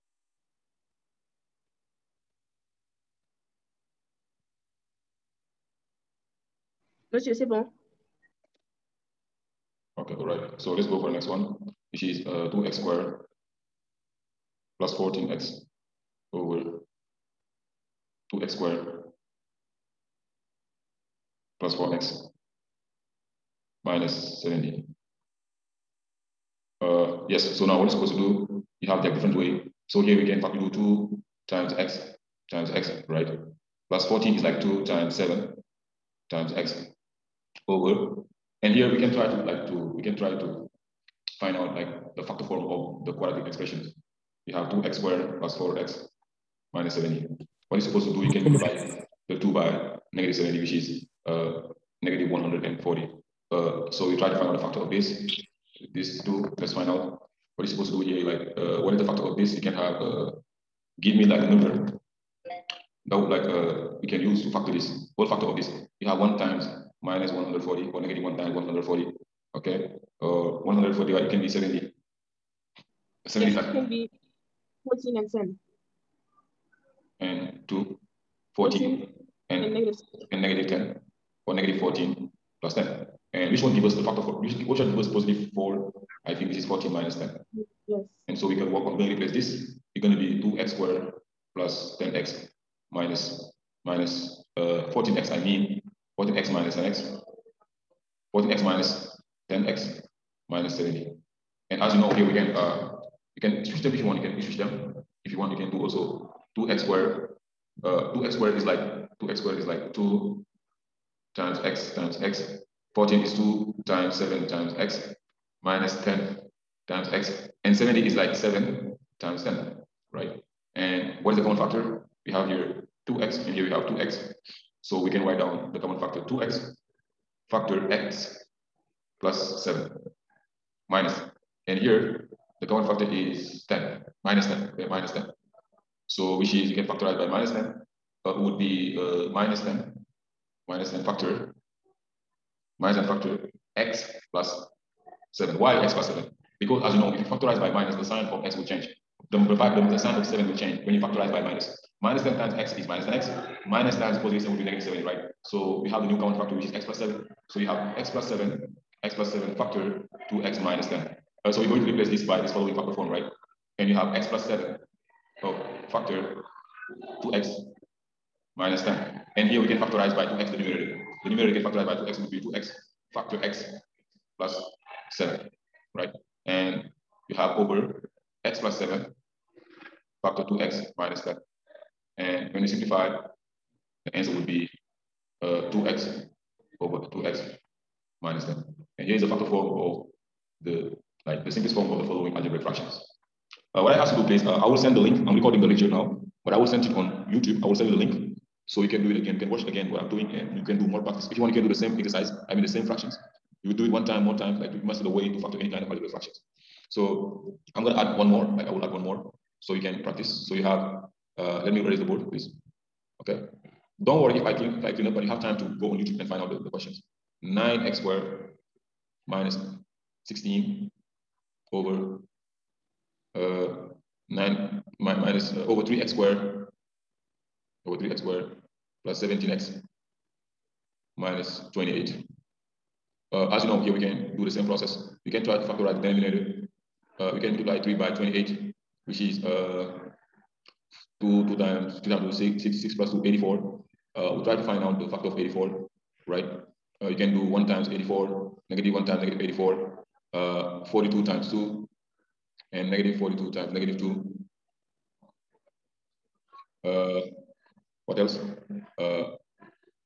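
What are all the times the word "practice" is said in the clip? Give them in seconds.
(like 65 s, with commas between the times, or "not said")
201 s, 210 s.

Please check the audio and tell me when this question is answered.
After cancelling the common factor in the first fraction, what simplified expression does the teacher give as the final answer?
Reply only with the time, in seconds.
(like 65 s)
185 s.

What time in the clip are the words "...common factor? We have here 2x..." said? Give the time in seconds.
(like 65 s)
121 s.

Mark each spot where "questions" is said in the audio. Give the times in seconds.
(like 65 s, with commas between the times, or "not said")
216 s.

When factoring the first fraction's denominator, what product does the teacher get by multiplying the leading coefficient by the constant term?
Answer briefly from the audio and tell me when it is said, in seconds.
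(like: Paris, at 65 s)
-140, at 52 s.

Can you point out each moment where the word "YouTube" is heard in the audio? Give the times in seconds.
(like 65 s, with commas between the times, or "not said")
197 s, 215 s.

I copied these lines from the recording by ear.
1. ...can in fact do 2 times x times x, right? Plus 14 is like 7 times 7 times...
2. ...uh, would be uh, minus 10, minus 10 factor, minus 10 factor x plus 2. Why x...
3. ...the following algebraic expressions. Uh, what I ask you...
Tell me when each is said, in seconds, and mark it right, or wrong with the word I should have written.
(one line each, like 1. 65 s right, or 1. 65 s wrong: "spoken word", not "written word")
1. 30 s wrong: "2", not "7"
2. 138 s wrong: "7", not "2"
3. 192 s wrong: "fractions", not "expressions".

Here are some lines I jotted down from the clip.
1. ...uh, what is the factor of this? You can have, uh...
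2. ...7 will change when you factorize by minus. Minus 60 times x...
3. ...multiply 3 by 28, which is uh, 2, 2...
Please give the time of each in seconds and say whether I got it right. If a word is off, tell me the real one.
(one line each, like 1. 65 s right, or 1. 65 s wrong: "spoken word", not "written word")
1. 58 s right
2. 150 s wrong: "10", not "60"
3. 237 s right.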